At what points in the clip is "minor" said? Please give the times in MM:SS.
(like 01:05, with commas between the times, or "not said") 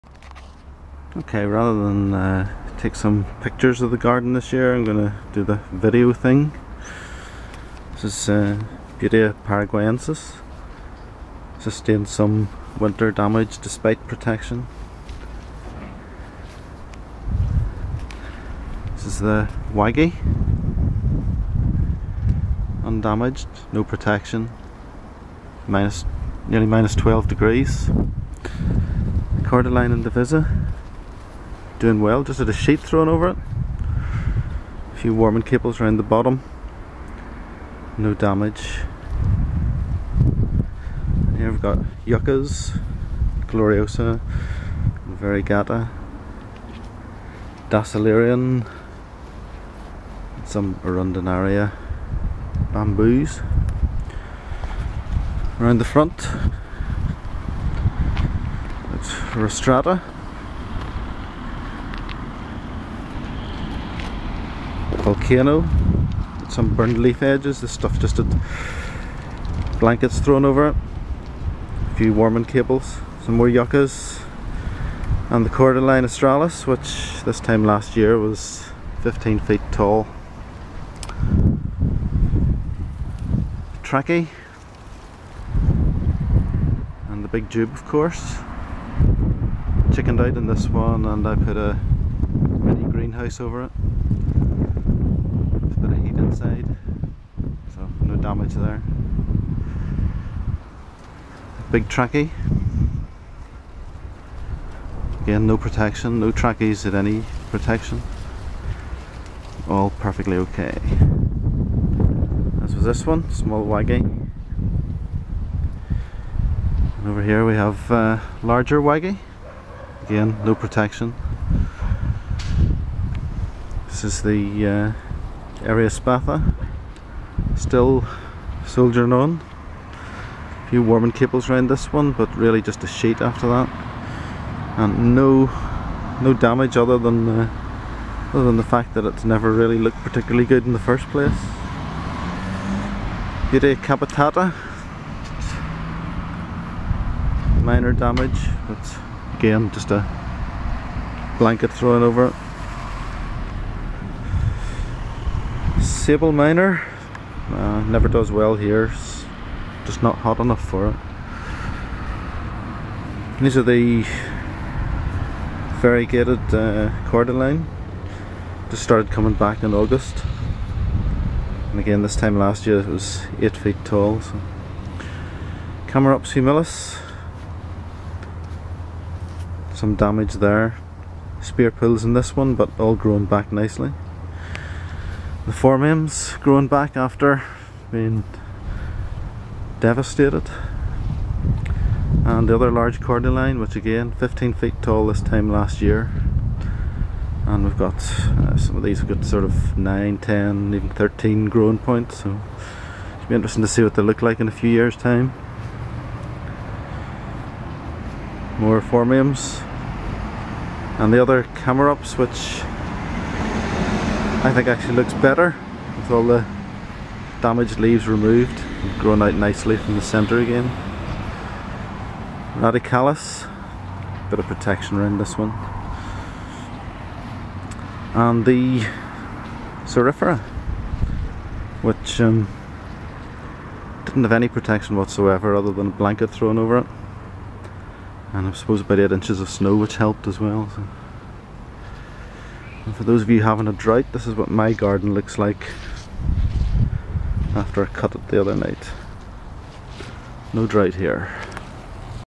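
02:27, 02:36.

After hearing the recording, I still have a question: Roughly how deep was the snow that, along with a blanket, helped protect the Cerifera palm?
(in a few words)
8 inches.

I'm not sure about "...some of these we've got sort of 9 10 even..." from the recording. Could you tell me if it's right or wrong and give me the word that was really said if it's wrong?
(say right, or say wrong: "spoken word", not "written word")
right.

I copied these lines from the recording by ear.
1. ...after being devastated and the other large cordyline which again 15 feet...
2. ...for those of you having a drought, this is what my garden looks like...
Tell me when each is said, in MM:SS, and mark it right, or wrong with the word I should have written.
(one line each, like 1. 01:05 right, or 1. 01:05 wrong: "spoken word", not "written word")
1. 03:06 right
2. 04:02 right.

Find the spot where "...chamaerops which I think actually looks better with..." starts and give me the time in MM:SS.
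03:31.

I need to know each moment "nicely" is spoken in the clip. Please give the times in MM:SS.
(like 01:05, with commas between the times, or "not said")
03:03, 03:39.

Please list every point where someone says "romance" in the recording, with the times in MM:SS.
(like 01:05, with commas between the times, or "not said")
not said.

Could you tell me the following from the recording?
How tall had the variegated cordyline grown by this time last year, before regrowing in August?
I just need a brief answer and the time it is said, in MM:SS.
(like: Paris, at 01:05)
8 feet, at 02:53.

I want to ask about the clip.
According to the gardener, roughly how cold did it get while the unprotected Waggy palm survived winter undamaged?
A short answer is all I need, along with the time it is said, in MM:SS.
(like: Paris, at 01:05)
-12 degrees, at 00:26.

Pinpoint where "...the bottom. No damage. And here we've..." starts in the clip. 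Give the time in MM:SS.
00:35.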